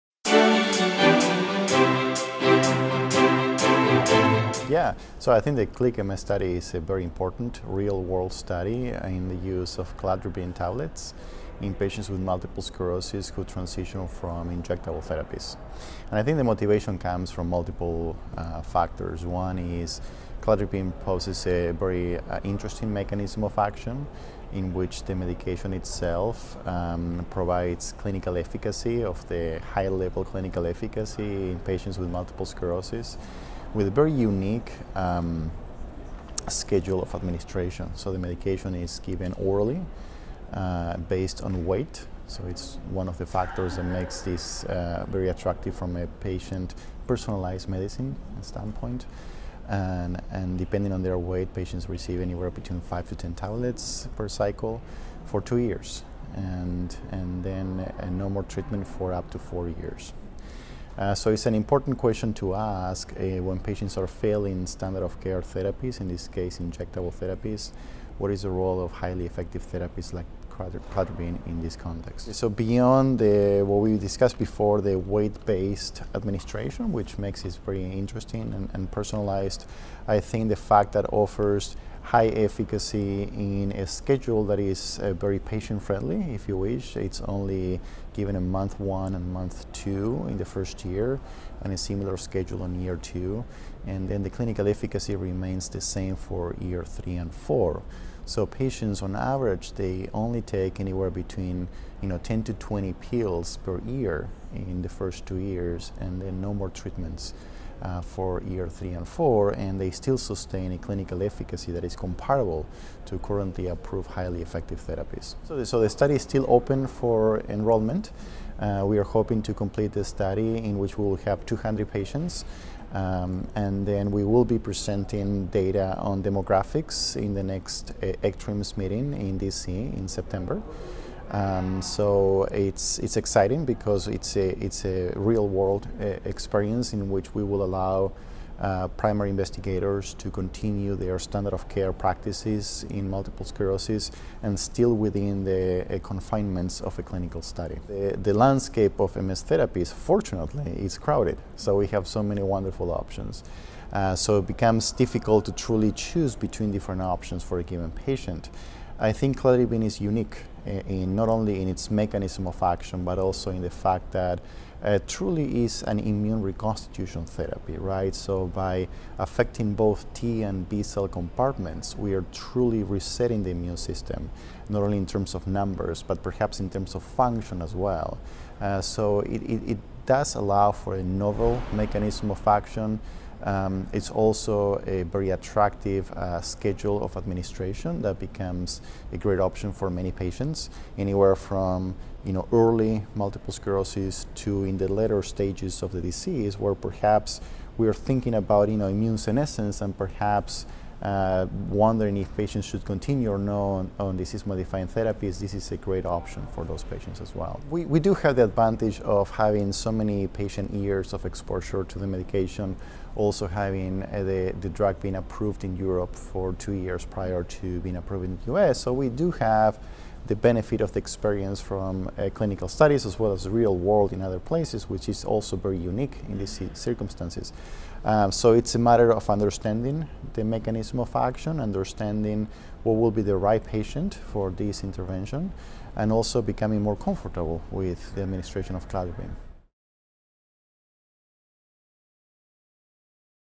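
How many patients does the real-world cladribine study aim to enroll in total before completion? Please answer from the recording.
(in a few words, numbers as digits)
200.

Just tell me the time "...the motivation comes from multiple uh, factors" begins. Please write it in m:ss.
0:16.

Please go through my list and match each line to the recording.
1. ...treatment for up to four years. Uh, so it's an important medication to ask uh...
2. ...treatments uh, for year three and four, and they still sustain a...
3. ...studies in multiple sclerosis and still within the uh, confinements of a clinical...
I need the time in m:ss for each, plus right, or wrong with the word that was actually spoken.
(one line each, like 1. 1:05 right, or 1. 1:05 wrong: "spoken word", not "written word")
1. 0:58 wrong: "question", not "medication"
2. 1:46 right
3. 2:21 wrong: "practices", not "studies".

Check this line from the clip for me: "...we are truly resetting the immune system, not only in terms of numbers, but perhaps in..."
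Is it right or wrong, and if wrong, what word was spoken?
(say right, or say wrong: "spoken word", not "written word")
right.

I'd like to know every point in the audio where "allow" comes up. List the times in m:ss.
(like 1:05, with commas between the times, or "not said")
2:17, 3:00.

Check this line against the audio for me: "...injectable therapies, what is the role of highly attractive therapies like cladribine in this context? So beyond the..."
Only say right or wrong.
wrong.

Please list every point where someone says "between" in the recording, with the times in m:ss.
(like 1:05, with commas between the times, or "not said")
0:52, 1:41, 2:36.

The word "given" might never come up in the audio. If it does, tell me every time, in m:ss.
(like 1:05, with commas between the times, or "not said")
0:38, 1:28, 2:37.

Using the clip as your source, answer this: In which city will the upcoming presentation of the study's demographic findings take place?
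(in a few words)
DC.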